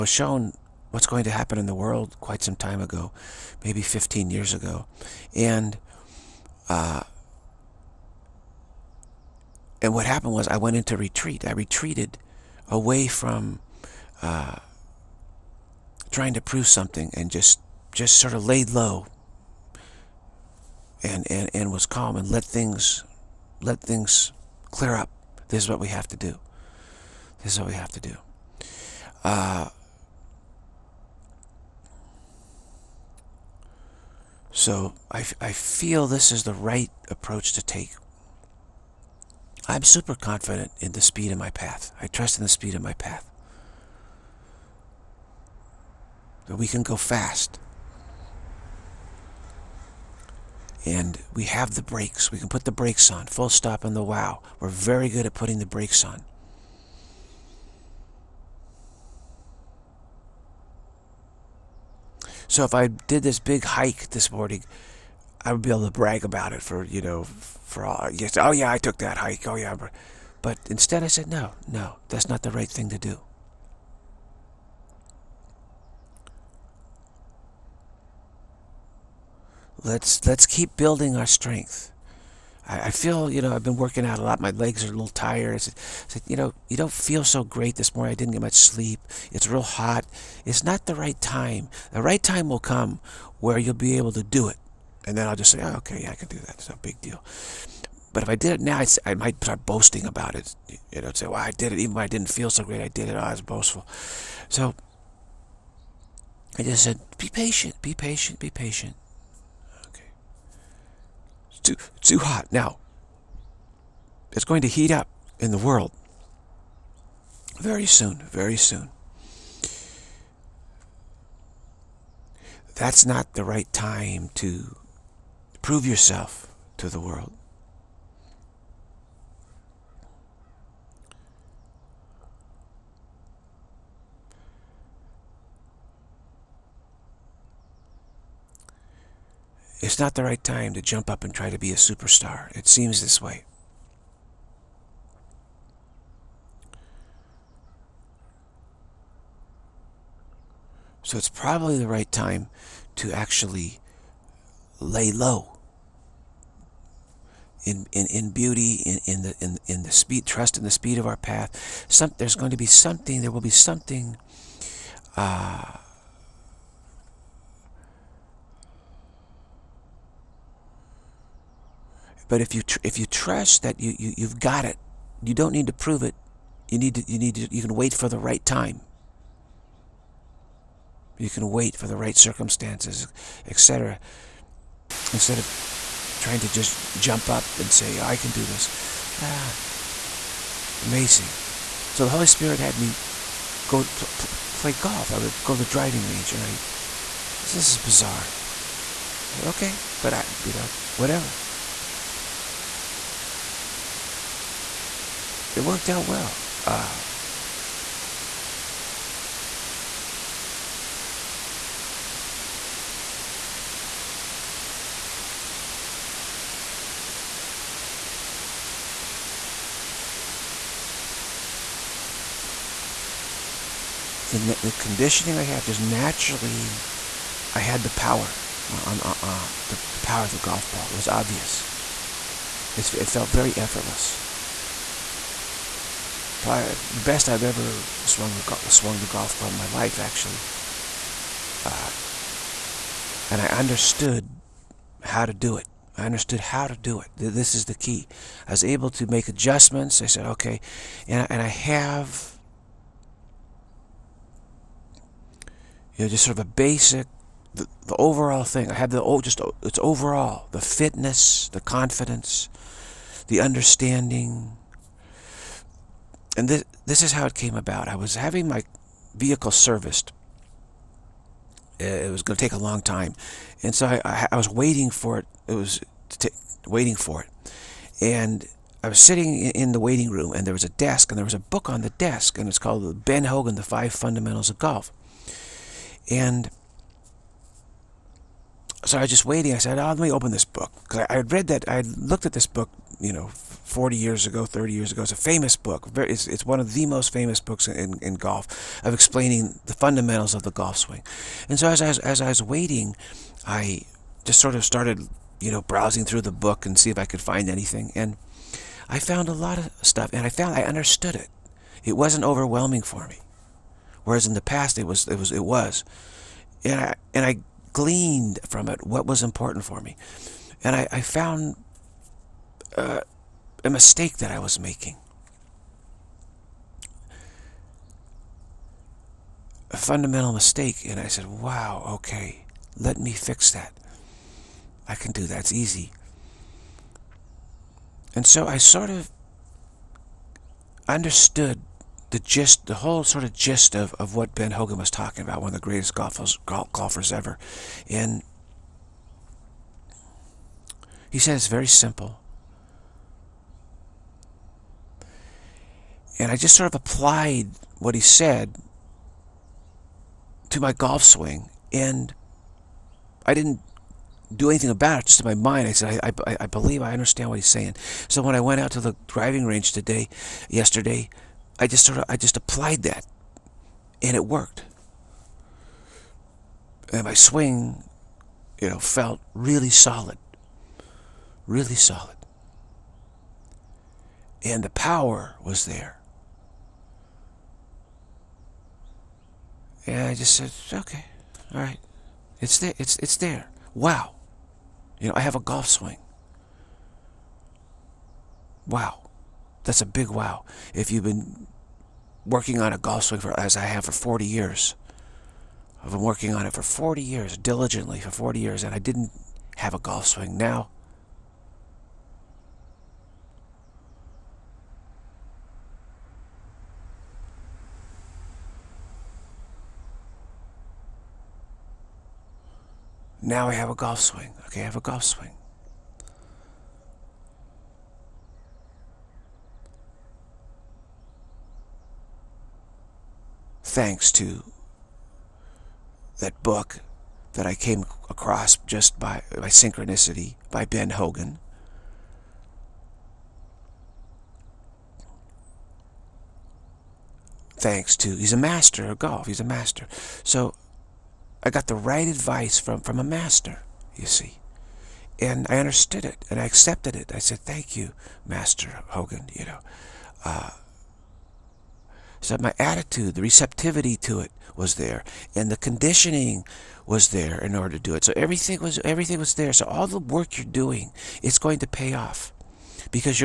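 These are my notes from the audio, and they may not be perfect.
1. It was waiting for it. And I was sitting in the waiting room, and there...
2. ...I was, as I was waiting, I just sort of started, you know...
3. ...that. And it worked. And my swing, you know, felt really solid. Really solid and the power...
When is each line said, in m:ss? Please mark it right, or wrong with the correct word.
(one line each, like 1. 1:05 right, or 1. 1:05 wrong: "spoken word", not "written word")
1. 4:35 right
2. 5:01 right
3. 6:12 right.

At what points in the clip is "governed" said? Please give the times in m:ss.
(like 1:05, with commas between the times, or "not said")
not said.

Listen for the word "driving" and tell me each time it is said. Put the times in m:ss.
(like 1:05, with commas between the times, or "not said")
3:15, 6:09.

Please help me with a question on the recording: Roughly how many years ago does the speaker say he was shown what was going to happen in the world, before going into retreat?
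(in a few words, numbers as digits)
15 years.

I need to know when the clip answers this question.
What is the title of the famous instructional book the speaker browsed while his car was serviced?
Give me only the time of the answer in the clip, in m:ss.
4:43.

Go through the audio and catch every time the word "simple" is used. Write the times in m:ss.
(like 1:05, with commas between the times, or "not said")
5:51.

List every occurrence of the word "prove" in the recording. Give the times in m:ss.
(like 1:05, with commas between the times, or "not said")
0:16, 2:05, 2:55.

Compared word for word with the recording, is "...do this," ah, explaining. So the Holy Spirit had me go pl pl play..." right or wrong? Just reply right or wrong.
wrong.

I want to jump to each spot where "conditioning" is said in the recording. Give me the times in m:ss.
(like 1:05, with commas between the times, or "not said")
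3:44, 7:45.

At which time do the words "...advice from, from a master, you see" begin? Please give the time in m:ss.
7:32.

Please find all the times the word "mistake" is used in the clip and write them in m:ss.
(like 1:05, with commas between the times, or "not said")
5:23, 5:30.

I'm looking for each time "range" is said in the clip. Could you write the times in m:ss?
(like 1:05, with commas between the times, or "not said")
3:16, 6:09.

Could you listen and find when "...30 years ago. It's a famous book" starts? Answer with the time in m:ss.
4:54.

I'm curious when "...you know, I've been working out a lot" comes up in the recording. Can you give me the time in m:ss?
1:23.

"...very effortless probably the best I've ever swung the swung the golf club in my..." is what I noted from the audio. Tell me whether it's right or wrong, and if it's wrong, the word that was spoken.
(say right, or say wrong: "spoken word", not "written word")
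right.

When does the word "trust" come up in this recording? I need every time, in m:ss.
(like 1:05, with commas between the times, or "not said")
0:42, 2:40, 2:53.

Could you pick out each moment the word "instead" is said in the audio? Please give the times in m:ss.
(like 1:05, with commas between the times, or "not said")
1:10, 3:05.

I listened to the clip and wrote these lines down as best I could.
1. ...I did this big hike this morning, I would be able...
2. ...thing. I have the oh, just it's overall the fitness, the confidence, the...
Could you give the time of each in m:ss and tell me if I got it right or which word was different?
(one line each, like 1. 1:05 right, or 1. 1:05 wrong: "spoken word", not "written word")
1. 1:02 right
2. 4:18 right.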